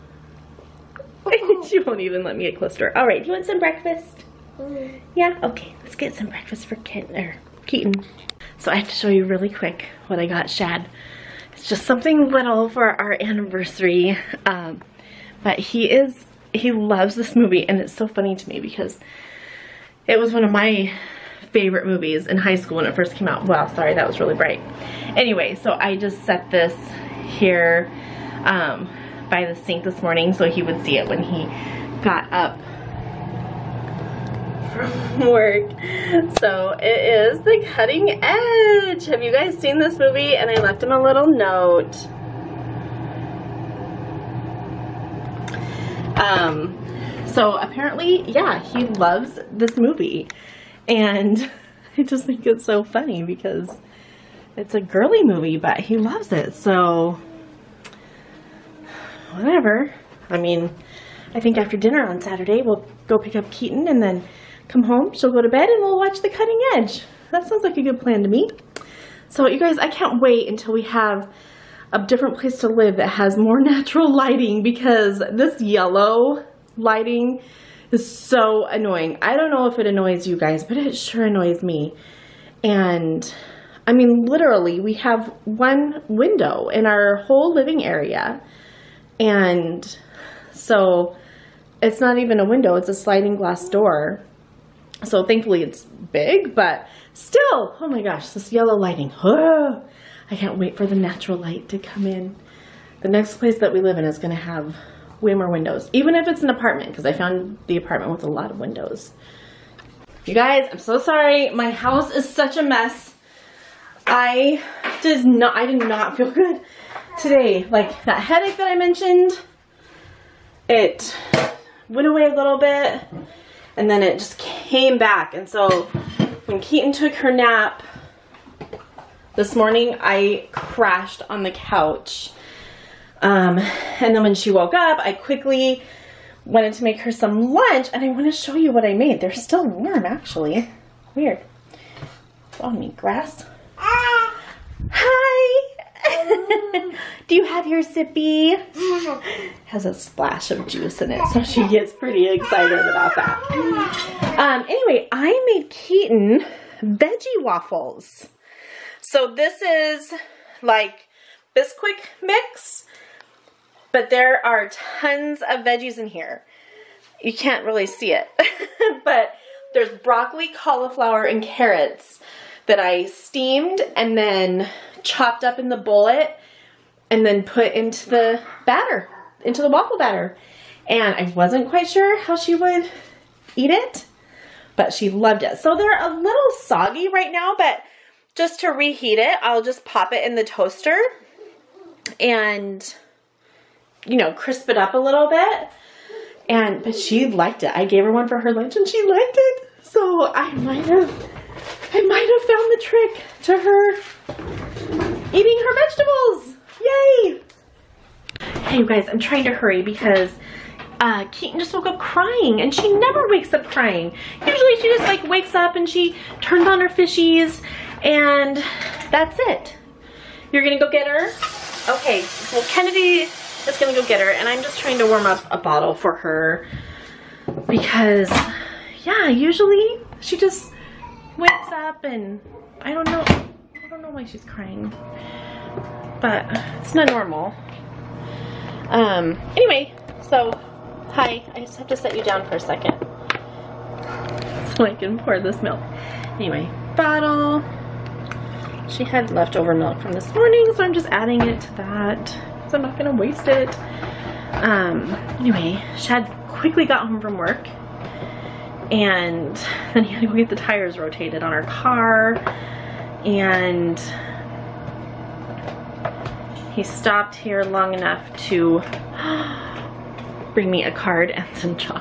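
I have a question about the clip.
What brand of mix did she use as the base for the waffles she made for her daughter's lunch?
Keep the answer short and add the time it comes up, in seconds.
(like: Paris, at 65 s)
Bisquick, at 161 s.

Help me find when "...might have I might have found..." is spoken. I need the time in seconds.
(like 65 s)
200 s.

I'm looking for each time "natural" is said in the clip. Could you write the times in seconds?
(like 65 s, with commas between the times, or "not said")
73 s, 100 s.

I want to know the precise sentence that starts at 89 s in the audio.
And so it's not even a window, it's a sliding glass door.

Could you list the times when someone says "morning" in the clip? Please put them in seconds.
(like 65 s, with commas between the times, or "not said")
30 s, 129 s, 250 s.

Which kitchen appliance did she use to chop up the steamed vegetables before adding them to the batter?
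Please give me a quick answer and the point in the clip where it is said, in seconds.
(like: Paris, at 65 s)
the bullet, at 175 s.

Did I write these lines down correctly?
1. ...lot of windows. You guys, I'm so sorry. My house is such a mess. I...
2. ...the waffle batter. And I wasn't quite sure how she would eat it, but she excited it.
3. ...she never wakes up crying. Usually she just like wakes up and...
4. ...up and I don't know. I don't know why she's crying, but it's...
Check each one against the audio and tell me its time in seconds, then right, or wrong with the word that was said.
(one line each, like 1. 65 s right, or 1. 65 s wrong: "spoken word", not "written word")
1. 108 s right
2. 179 s wrong: "loved", not "excited"
3. 212 s right
4. 231 s right.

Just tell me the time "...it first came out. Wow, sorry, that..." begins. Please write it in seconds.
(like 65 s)
22 s.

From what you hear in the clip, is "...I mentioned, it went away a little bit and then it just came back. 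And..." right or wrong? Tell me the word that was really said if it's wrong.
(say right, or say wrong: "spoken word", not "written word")
right.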